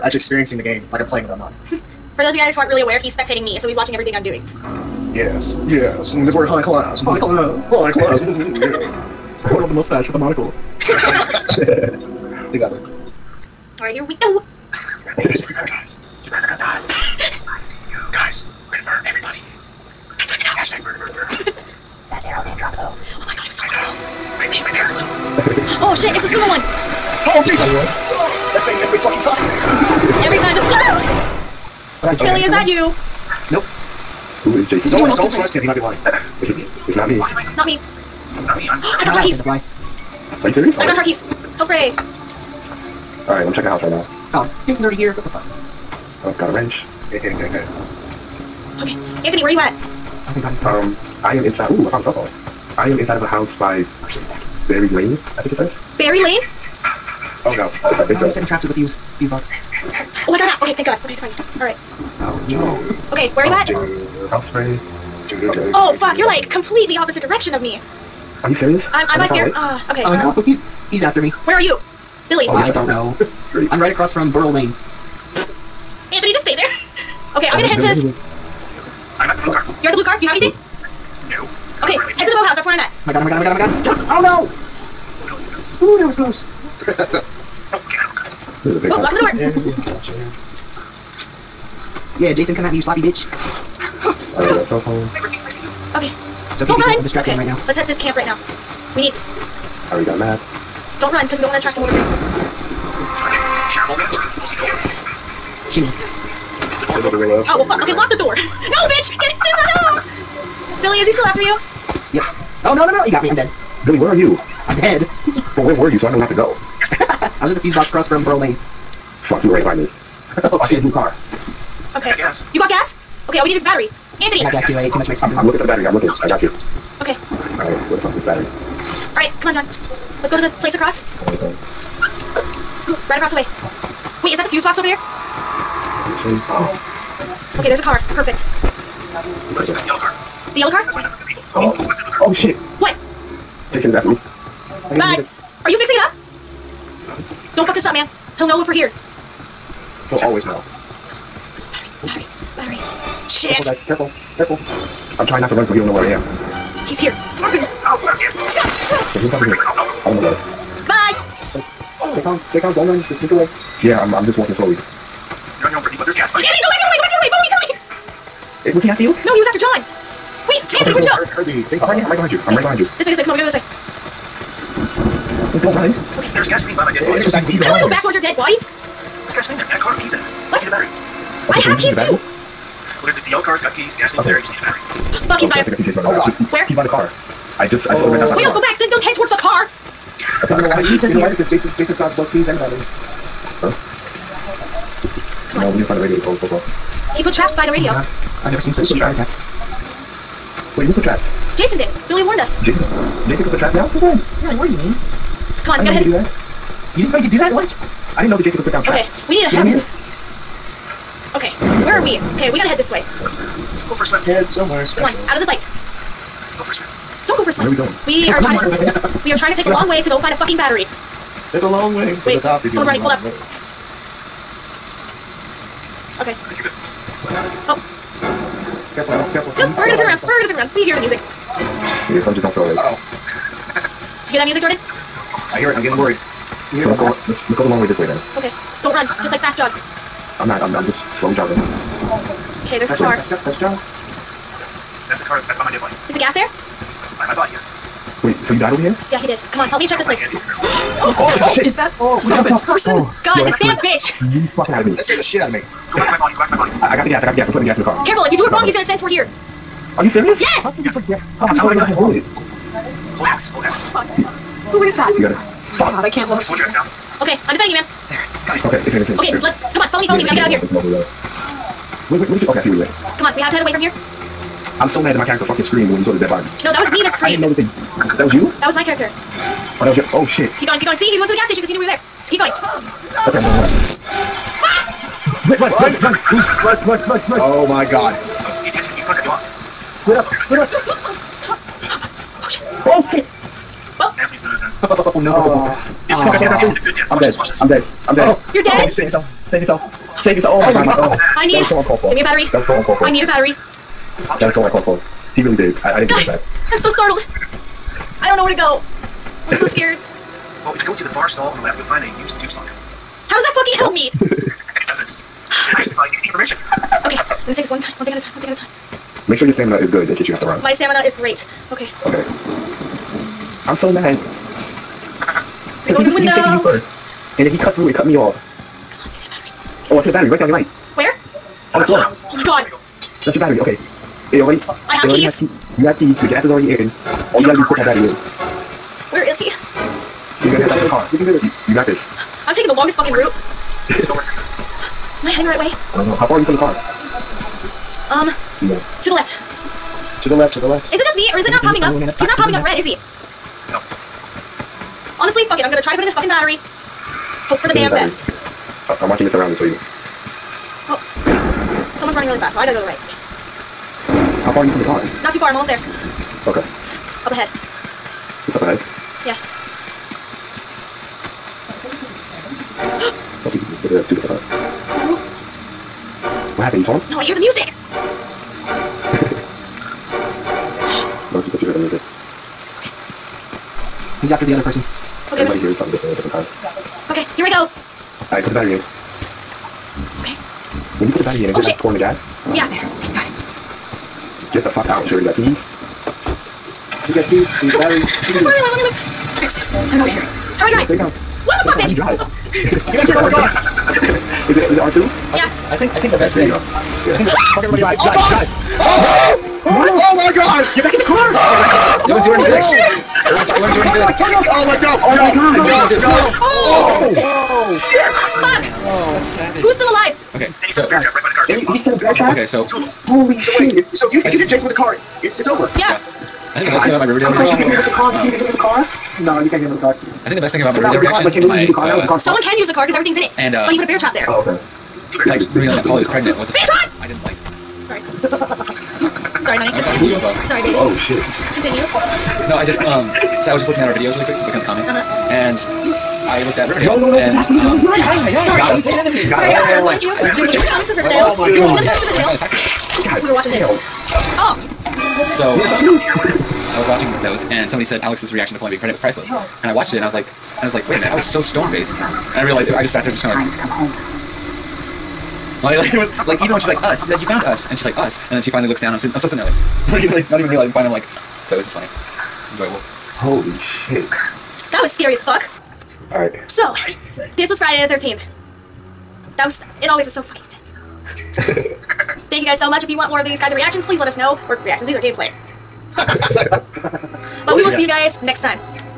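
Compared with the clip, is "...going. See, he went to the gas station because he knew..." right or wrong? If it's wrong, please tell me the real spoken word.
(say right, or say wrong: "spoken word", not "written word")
right.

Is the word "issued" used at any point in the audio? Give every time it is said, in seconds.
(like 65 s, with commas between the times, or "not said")
not said.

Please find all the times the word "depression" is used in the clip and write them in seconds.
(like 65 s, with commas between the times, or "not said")
not said.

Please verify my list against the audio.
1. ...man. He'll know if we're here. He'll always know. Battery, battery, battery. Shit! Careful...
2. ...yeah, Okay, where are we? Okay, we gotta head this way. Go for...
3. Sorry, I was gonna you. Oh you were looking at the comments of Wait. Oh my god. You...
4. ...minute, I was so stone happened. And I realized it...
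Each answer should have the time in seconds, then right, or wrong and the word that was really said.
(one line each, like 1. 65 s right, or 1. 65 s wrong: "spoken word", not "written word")
1. 147 s right
2. 209 s right
3. 449 s wrong: "Riverdale", not "Wait"
4. 460 s wrong: "faced", not "happened".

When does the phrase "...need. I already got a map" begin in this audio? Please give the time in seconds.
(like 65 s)
99 s.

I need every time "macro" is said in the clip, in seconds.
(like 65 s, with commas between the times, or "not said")
not said.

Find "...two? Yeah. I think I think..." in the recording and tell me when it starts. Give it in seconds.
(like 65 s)
404 s.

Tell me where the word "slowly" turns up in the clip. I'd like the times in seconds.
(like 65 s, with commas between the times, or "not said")
164 s, 241 s.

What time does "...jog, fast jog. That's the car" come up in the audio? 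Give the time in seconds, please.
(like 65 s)
243 s.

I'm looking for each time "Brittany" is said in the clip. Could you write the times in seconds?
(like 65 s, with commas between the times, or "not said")
165 s.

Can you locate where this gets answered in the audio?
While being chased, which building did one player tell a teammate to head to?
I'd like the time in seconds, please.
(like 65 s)
81 s.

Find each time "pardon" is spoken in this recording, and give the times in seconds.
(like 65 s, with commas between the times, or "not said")
not said.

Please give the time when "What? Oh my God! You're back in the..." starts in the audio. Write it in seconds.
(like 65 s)
409 s.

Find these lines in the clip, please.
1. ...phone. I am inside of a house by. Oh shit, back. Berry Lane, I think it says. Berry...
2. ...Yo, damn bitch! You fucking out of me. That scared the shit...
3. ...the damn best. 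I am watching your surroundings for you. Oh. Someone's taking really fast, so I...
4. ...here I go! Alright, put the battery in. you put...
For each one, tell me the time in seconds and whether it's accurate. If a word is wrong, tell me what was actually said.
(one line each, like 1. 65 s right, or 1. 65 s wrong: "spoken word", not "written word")
1. 52 s right
2. 253 s right
3. 357 s wrong: "running", not "taking"
4. 387 s right.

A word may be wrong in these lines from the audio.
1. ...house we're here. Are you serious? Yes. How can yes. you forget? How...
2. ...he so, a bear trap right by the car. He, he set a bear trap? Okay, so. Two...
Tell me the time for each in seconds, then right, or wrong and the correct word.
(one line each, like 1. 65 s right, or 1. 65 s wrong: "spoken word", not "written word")
1. 258 s wrong: "sense", not "house"
2. 420 s right.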